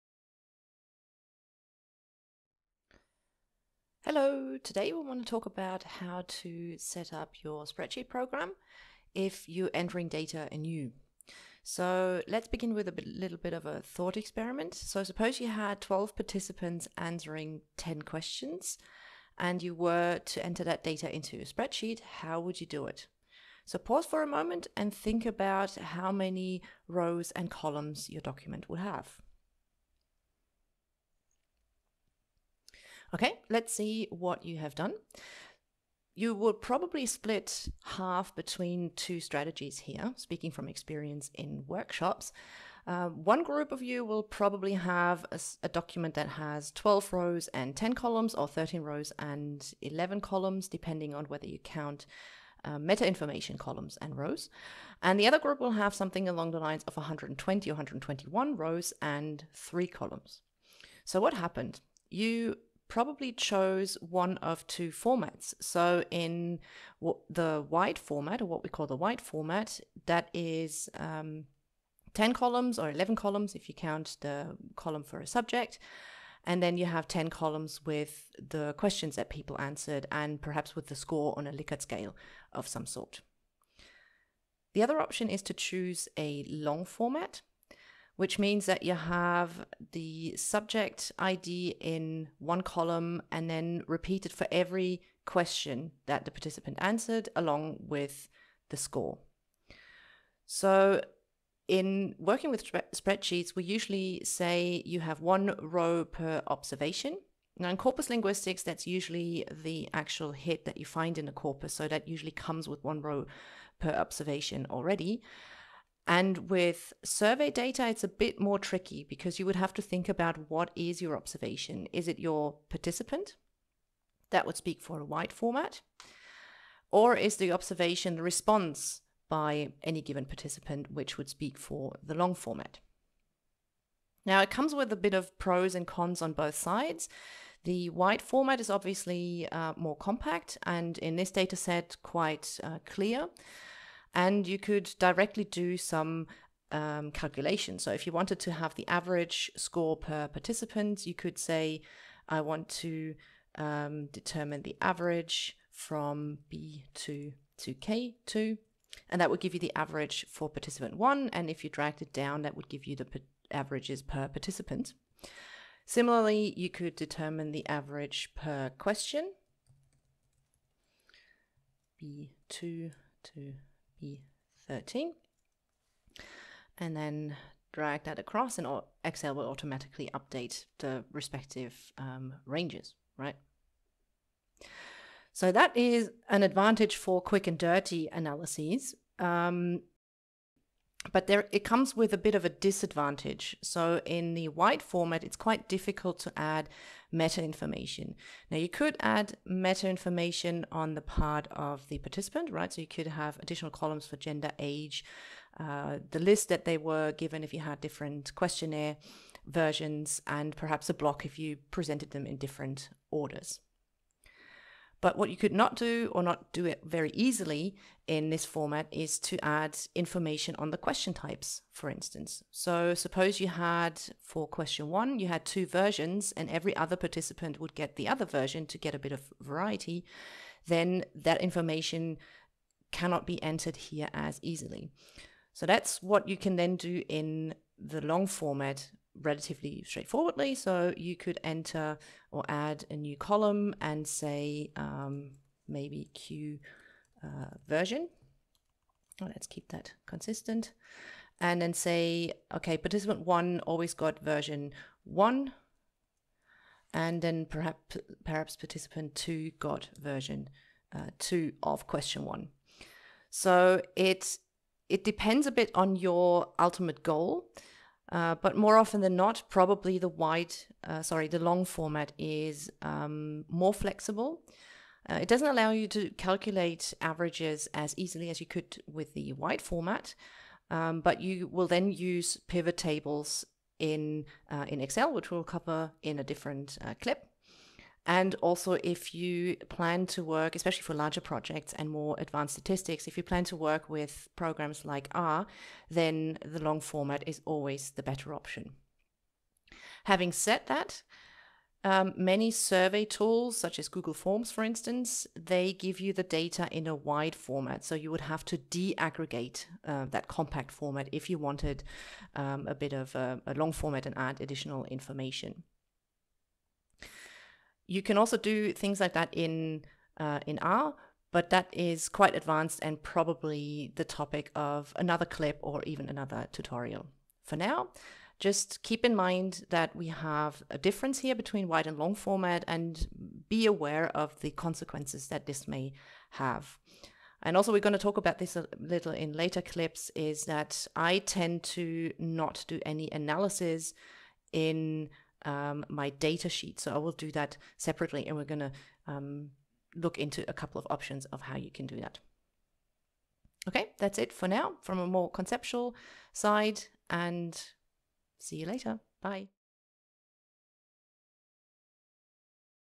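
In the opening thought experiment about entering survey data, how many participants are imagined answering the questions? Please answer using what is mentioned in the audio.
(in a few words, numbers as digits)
12.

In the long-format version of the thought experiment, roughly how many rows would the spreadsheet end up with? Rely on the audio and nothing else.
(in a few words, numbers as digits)
120 or 121.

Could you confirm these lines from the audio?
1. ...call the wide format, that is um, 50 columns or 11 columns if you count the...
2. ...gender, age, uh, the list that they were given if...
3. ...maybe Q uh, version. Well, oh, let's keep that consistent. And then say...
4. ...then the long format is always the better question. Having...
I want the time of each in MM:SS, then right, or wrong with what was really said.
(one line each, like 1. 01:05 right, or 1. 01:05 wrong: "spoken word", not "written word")
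1. 01:08 wrong: "10", not "50"
2. 03:24 right
3. 04:05 right
4. 04:55 wrong: "option", not "question".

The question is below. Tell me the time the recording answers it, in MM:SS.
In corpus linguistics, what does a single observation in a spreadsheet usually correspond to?
01:49.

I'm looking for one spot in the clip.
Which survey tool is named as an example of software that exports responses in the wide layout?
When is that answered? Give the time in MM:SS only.
05:03.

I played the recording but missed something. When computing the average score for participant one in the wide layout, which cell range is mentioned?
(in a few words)
B2 to K2.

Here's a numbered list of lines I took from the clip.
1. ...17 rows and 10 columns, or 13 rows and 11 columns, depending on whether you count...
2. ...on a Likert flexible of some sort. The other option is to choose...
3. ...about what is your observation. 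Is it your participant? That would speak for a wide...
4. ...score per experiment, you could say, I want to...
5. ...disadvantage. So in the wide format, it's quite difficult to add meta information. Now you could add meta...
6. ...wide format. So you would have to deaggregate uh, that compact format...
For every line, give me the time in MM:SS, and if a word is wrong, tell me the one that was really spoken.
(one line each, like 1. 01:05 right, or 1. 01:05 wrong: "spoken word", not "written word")
1. 00:46 wrong: "12", not "17"
2. 01:21 wrong: "scale", not "flexible"
3. 02:00 right
4. 02:29 wrong: "participant", not "experiment"
5. 03:12 right
6. 05:06 right.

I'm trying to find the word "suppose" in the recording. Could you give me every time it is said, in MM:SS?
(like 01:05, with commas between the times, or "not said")
00:15, 03:42.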